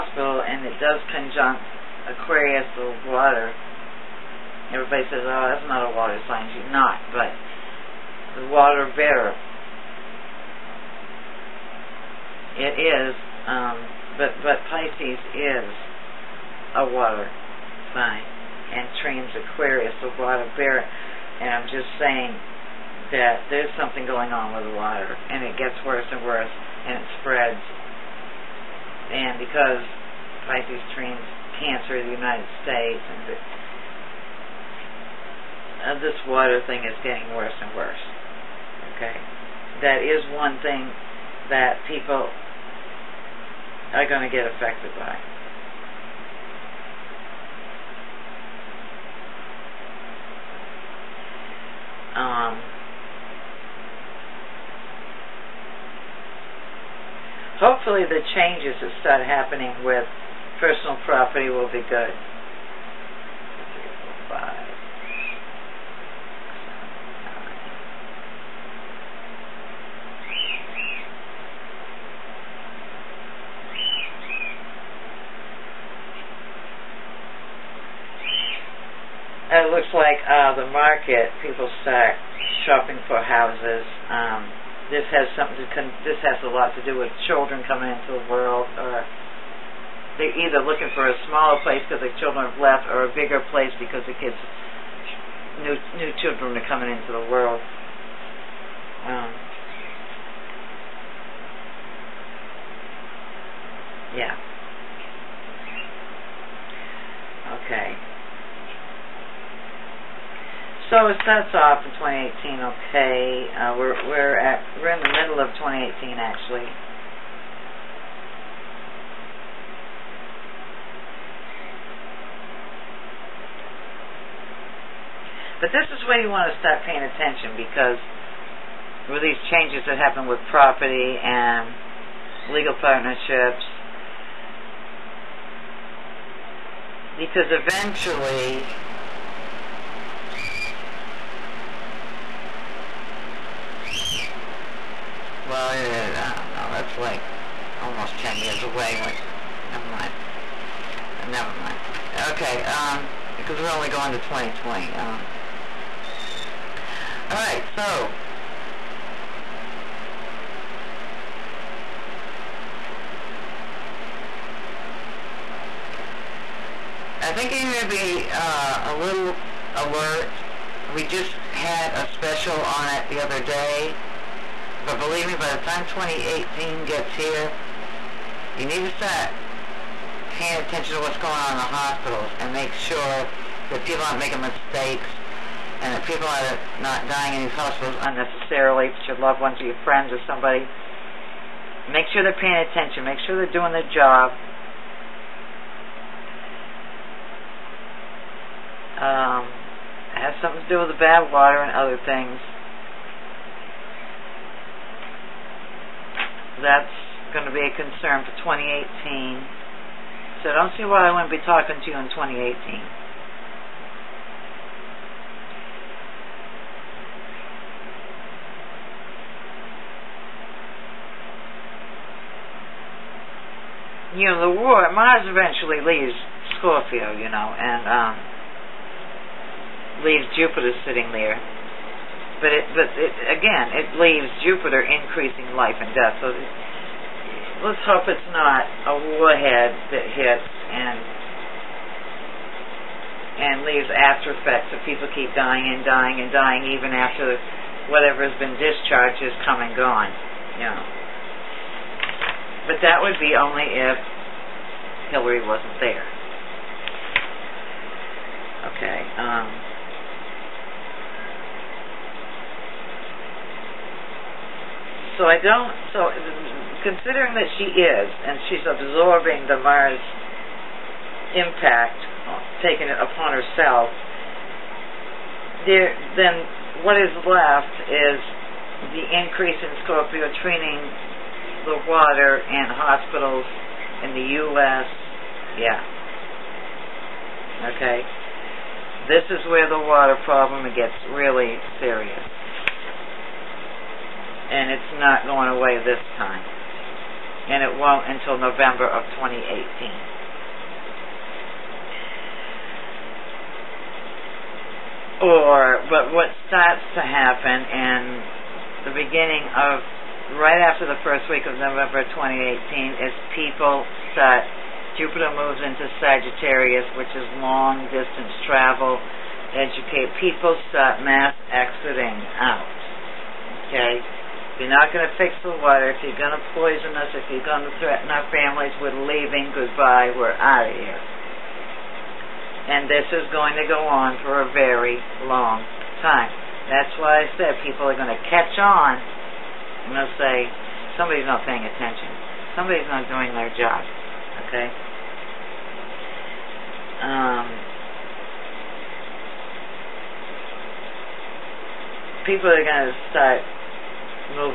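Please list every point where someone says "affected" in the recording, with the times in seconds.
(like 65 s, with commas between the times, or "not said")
44 s.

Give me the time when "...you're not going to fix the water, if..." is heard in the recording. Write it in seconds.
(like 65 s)
324 s.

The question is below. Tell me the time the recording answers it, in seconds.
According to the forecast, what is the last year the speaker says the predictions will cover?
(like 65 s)
153 s.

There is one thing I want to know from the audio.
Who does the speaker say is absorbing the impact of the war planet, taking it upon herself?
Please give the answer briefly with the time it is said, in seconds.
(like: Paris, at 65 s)
Hillary, at 255 s.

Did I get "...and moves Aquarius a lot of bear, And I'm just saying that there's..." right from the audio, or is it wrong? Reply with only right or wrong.
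wrong.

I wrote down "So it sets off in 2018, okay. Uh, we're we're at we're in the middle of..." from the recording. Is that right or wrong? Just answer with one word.
right.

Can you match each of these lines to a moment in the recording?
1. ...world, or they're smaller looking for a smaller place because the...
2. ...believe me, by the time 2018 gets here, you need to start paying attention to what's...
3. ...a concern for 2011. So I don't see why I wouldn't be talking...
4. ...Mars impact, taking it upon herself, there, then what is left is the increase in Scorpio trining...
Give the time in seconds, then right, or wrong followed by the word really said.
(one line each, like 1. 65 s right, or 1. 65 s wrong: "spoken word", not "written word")
1. 88 s wrong: "either", not "smaller"
2. 175 s right
3. 207 s wrong: "2018", not "2011"
4. 269 s right.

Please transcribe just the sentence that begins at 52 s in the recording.
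Um, hopefully the changes that start happening with personal property will be good.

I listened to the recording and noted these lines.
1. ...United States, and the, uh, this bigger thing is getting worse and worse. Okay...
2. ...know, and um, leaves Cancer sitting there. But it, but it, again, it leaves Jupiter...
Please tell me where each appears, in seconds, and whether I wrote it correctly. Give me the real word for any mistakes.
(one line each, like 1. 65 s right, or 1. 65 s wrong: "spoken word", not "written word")
1. 32 s wrong: "water", not "bigger"
2. 227 s wrong: "Jupiter", not "Cancer".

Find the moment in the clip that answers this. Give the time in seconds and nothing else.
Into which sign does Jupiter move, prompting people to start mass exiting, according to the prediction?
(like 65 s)
315 s.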